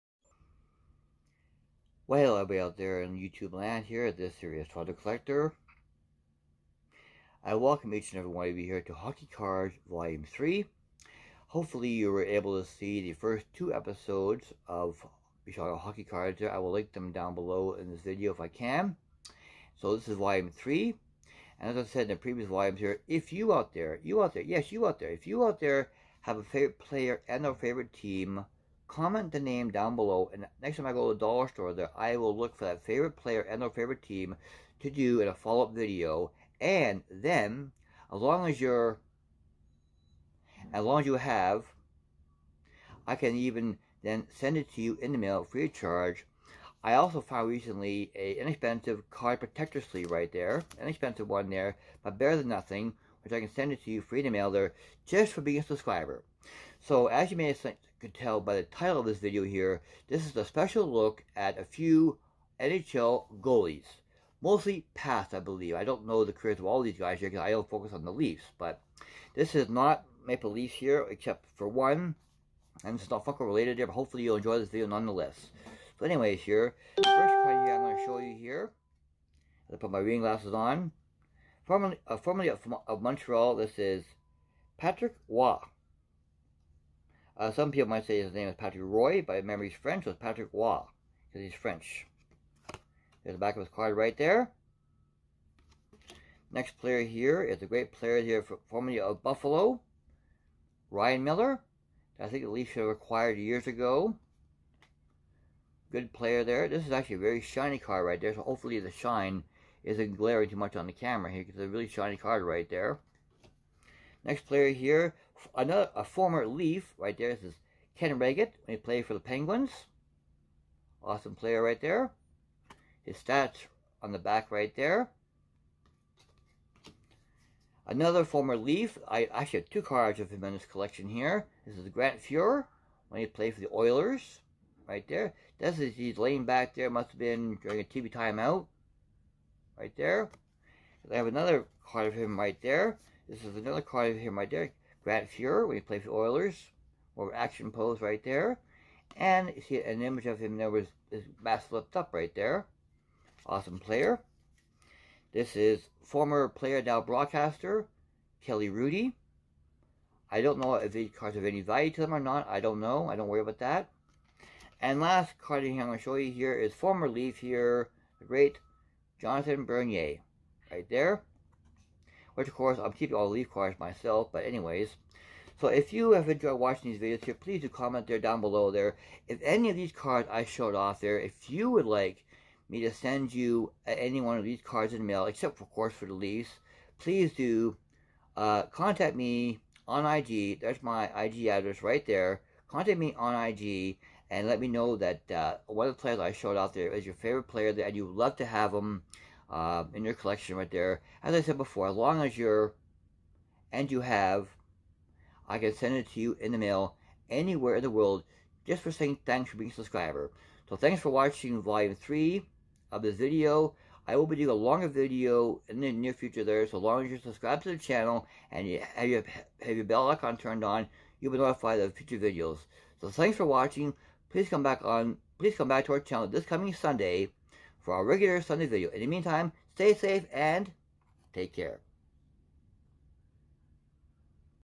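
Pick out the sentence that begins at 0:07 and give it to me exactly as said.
I welcome each and every one of you here to Hockey Cards Volume 3.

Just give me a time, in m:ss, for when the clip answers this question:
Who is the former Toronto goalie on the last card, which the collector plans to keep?
2:49.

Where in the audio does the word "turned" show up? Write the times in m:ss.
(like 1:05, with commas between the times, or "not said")
3:40.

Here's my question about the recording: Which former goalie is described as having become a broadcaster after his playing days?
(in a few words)
Kelly Hrudey.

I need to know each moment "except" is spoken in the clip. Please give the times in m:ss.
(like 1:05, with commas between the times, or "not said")
1:11, 3:05.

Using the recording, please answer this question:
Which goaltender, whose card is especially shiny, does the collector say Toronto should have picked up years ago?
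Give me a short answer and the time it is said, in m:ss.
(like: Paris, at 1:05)
Ryan Miller, at 1:40.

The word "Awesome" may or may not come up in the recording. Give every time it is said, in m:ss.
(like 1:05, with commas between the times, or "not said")
2:01, 2:33.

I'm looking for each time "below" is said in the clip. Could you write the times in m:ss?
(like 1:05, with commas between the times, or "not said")
0:17, 0:29, 2:58.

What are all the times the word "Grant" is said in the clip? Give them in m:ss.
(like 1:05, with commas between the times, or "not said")
2:11, 2:25.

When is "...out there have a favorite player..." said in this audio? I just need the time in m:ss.
0:25.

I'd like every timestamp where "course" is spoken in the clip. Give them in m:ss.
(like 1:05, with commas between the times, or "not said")
2:52, 3:05.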